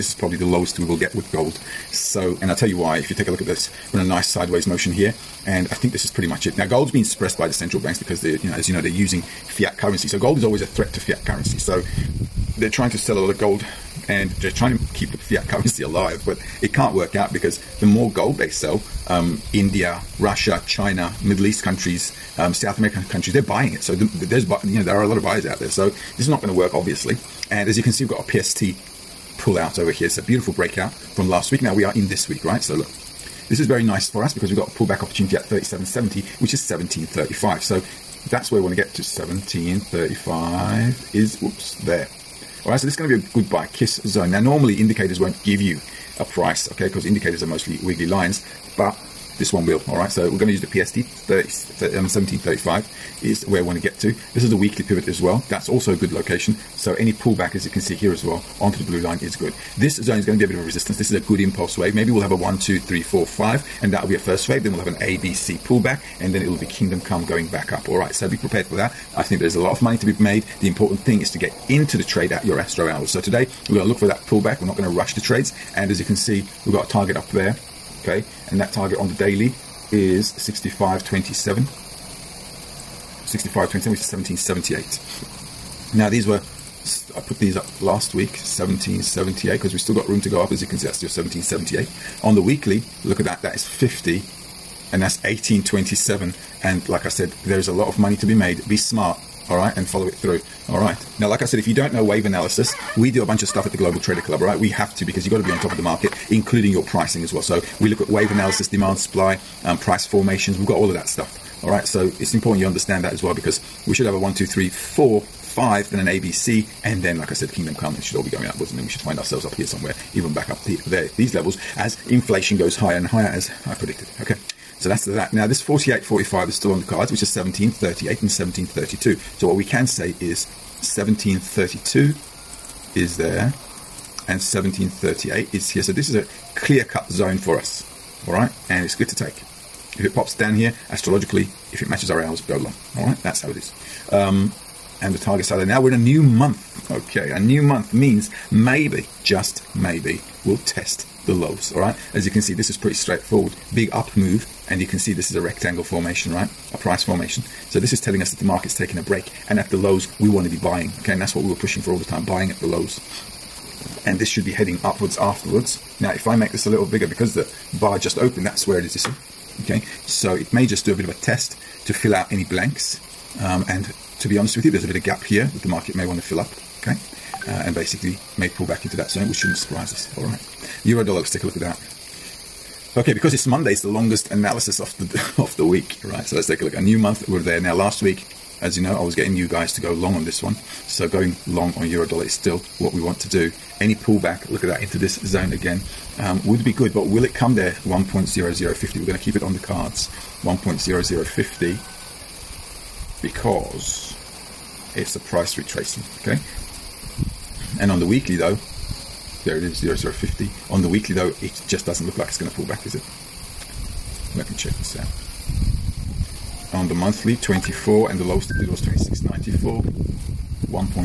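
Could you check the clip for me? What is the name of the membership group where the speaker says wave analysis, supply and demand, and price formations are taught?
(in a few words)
Global Trader Club.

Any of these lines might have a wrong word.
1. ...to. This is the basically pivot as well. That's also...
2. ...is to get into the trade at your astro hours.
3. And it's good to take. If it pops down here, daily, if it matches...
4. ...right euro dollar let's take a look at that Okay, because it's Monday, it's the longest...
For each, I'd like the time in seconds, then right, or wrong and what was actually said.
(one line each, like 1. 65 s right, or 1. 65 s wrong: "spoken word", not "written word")
1. 53 s wrong: "weekly", not "basically"
2. 71 s right
3. 138 s wrong: "astrologically", not "daily"
4. 180 s right.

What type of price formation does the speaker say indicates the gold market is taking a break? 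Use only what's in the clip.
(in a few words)
rectangle formation.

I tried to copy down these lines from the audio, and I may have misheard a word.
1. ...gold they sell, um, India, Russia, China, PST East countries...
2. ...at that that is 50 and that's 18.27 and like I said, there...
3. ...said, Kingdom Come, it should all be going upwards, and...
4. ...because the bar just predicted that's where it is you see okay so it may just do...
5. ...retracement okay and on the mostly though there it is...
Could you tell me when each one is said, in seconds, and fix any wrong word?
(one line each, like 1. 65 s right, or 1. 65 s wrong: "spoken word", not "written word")
1. 18 s wrong: "Middle", not "PST"
2. 93 s right
3. 117 s right
4. 167 s wrong: "opened", not "predicted"
5. 205 s wrong: "weekly", not "mostly".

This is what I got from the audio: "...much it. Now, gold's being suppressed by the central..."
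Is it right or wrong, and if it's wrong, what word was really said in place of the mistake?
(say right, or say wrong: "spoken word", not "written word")
right.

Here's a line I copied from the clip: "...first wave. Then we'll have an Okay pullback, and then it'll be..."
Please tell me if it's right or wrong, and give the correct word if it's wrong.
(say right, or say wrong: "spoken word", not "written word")
wrong: "ABC", not "Okay".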